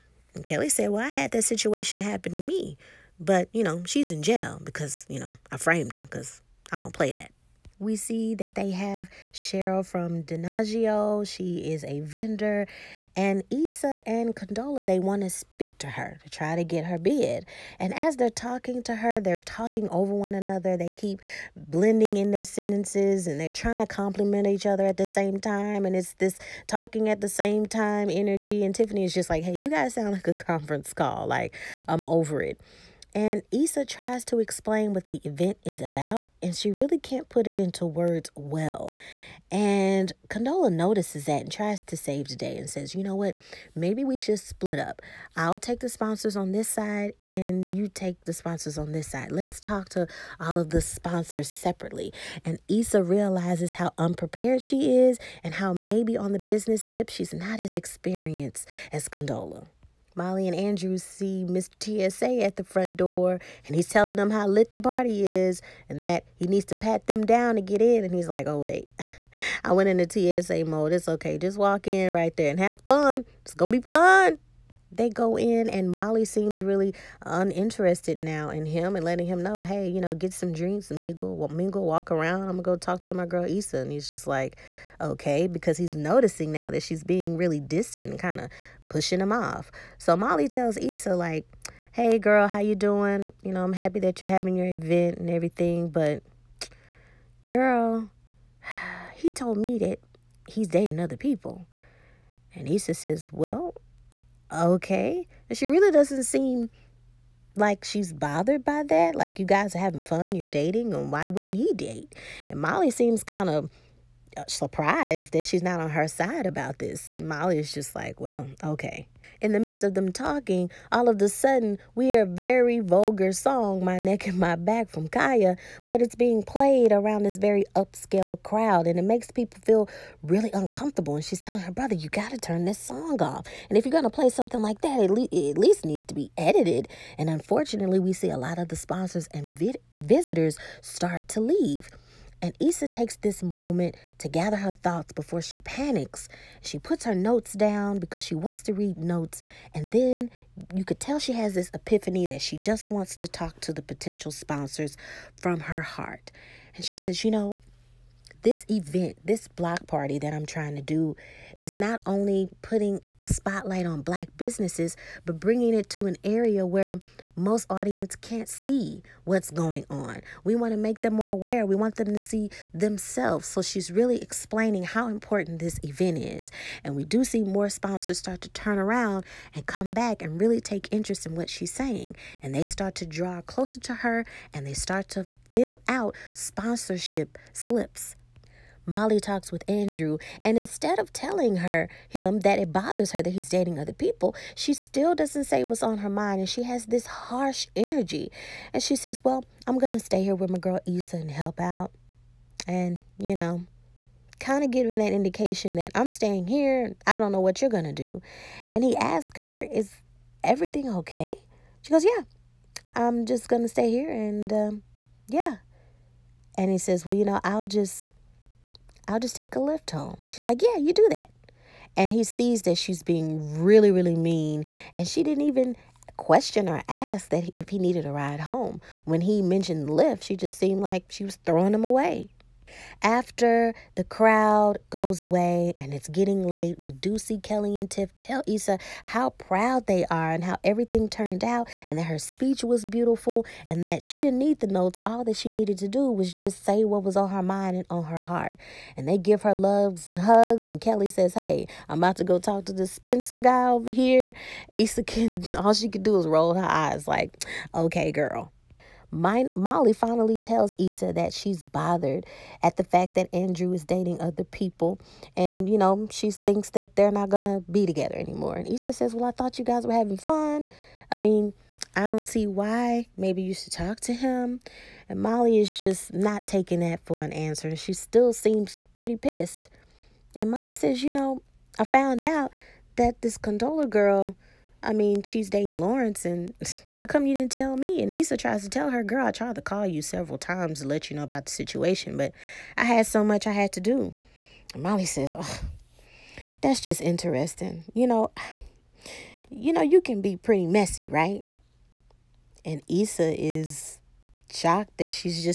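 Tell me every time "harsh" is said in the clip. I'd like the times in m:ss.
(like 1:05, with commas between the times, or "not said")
3:17.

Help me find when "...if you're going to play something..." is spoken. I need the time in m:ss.
2:13.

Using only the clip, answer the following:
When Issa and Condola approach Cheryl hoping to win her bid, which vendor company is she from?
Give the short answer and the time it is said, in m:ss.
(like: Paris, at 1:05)
Denagio, at 0:10.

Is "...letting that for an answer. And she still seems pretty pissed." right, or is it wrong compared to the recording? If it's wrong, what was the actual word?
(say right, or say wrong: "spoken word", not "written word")
wrong: "taking", not "letting".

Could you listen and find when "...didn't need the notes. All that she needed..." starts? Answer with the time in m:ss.
4:04.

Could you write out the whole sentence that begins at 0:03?
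But, you know, she's in jail because, you know, I framed her because I don't play that.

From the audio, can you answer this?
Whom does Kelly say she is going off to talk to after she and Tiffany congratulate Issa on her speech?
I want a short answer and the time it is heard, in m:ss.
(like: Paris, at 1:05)
The Spencer guy, at 4:12.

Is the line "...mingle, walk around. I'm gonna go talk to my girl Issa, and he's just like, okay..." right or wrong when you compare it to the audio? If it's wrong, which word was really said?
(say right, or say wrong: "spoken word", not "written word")
right.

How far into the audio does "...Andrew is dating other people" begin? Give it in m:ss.
4:23.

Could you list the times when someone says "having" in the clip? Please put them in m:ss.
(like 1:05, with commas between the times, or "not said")
1:34, 1:49, 4:29.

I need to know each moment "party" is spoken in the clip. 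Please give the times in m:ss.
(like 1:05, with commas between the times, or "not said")
1:04, 2:39.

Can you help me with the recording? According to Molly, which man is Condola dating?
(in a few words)
Lawrence.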